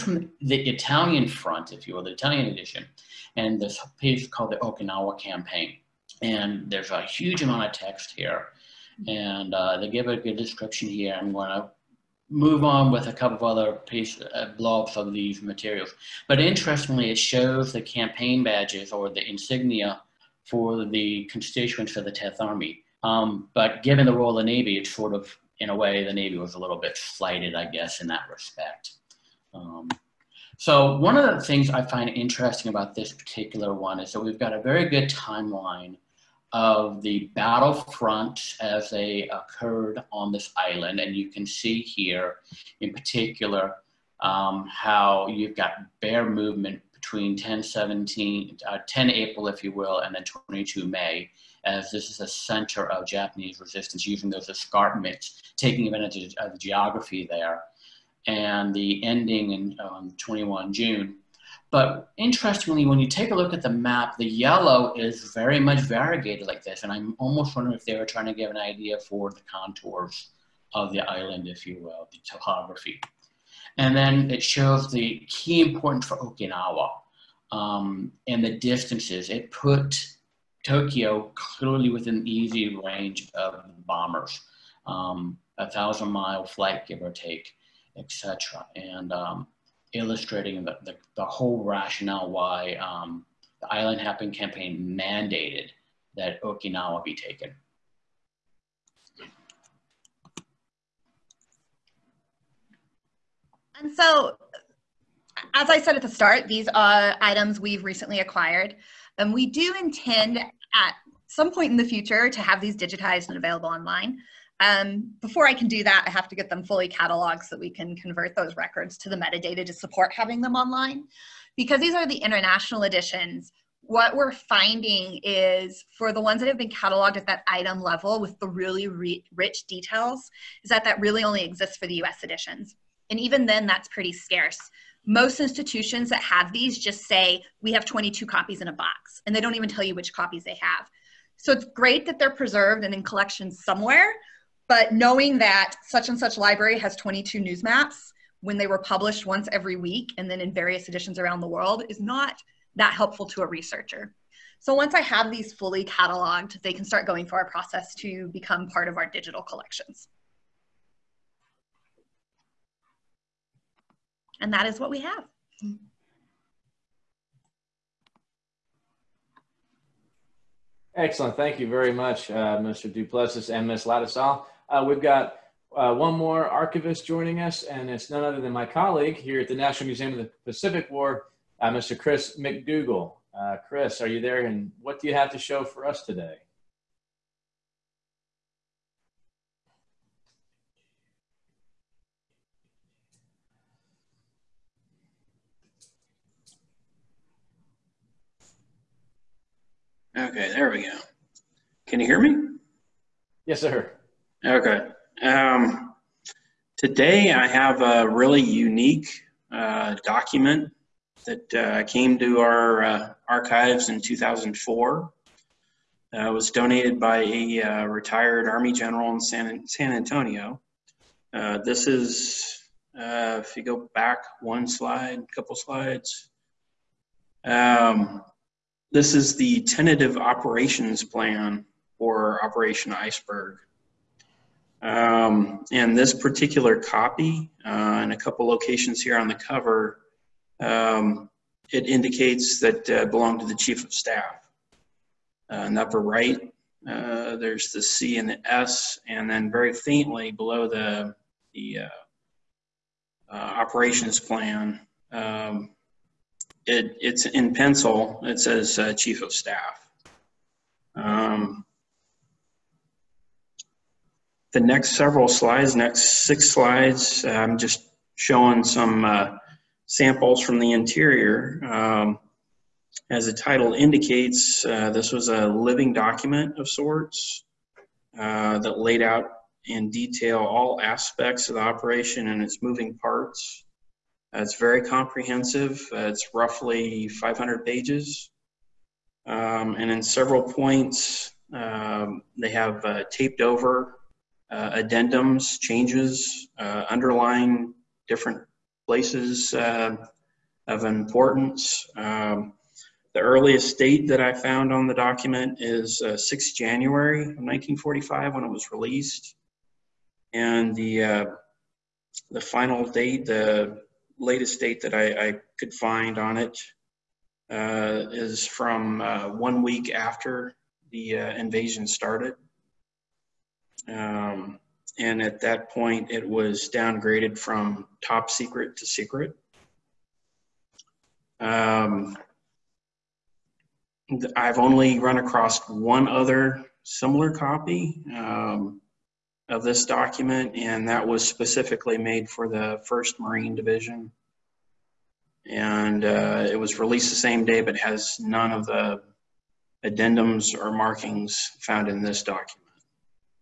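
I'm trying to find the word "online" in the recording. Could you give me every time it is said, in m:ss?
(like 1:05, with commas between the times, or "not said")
1:53, 2:00.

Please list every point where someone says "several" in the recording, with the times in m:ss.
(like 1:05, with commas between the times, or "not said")
4:24, 4:50.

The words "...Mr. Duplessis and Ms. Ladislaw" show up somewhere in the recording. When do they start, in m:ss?
2:52.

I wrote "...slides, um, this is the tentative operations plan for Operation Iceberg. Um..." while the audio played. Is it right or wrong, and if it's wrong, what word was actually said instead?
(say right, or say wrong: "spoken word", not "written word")
right.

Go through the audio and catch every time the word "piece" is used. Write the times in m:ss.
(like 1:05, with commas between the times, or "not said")
0:03, 0:13.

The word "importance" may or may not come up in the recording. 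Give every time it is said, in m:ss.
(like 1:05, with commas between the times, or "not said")
1:15, 5:00.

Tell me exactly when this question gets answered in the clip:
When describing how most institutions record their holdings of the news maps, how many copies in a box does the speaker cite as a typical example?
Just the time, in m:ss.
2:17.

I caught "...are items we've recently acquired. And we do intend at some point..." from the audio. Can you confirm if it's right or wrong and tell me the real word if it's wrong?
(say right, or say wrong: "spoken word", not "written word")
right.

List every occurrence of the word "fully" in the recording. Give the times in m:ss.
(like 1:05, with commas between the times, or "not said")
1:56, 2:35.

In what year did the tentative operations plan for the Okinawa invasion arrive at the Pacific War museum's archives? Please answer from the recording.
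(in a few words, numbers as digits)
2004.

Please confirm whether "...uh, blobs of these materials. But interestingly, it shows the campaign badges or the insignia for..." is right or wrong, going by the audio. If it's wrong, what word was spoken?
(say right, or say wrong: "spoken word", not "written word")
right.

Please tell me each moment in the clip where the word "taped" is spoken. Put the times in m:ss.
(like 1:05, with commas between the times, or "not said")
4:53.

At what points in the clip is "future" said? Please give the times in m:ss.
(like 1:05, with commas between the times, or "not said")
1:51.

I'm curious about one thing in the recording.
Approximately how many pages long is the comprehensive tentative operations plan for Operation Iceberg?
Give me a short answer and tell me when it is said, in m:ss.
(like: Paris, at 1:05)
500, at 4:46.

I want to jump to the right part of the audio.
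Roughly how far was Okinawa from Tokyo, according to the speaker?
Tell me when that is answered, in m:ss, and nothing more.
1:25.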